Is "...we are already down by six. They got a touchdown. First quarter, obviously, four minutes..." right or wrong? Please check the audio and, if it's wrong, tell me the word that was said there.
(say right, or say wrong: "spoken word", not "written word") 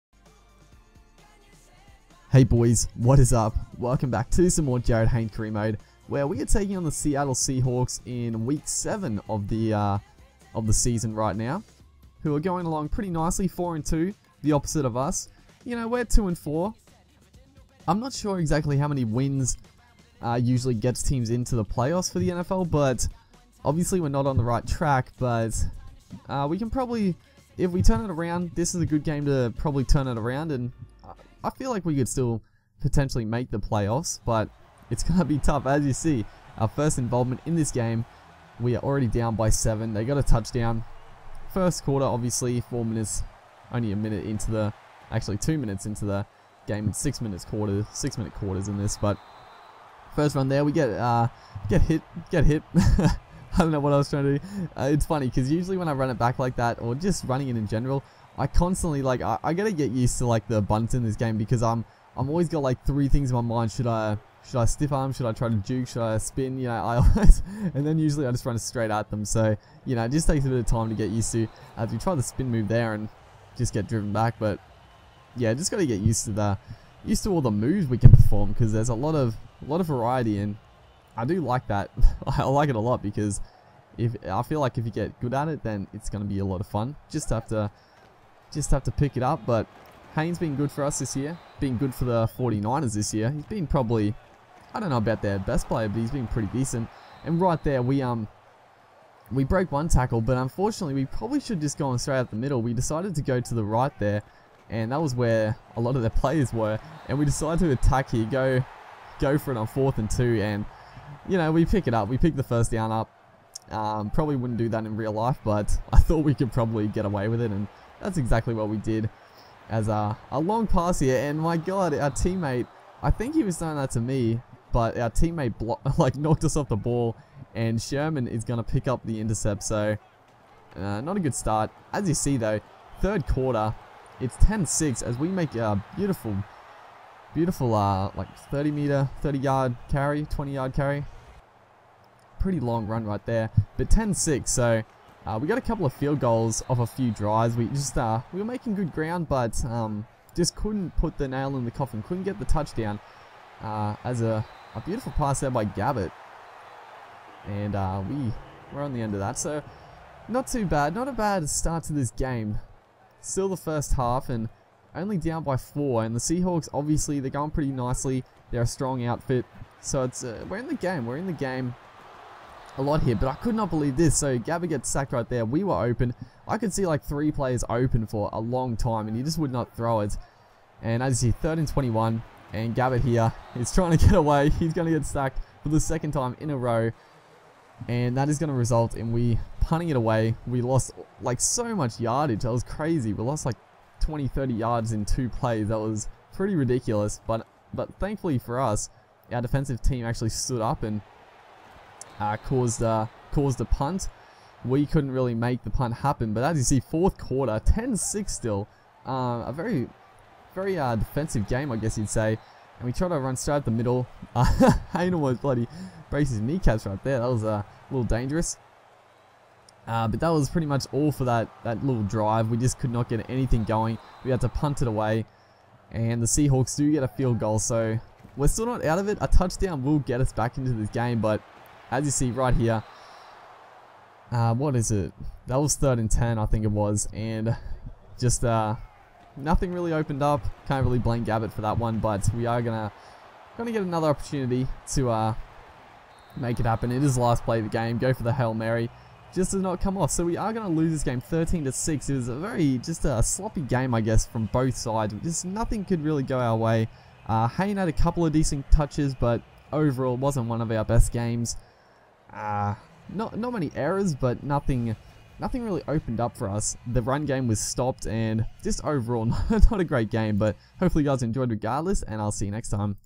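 wrong: "seven", not "six".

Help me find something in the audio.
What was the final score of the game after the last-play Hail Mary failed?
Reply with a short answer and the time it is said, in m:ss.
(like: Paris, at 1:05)
13 to 6, at 4:11.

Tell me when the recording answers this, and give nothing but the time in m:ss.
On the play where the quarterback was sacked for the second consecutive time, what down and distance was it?
3:01.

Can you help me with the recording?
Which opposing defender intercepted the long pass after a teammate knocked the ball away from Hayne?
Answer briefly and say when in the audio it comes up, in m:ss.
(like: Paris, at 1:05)
Sherman, at 2:07.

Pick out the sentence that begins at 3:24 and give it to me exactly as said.
We couldn't really make the punt happen, but as you see, fourth quarter, 10-6 still.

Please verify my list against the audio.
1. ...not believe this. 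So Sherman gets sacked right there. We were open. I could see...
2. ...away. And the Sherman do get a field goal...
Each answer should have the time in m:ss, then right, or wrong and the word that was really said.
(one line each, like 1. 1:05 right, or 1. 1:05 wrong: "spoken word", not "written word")
1. 2:53 wrong: "Gabbert", not "Sherman"
2. 3:44 wrong: "Seahawks", not "Sherman".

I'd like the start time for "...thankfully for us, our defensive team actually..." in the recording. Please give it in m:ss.
3:17.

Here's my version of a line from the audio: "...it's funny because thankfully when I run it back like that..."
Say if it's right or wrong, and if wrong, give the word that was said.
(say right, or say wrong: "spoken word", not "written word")
wrong: "usually", not "thankfully".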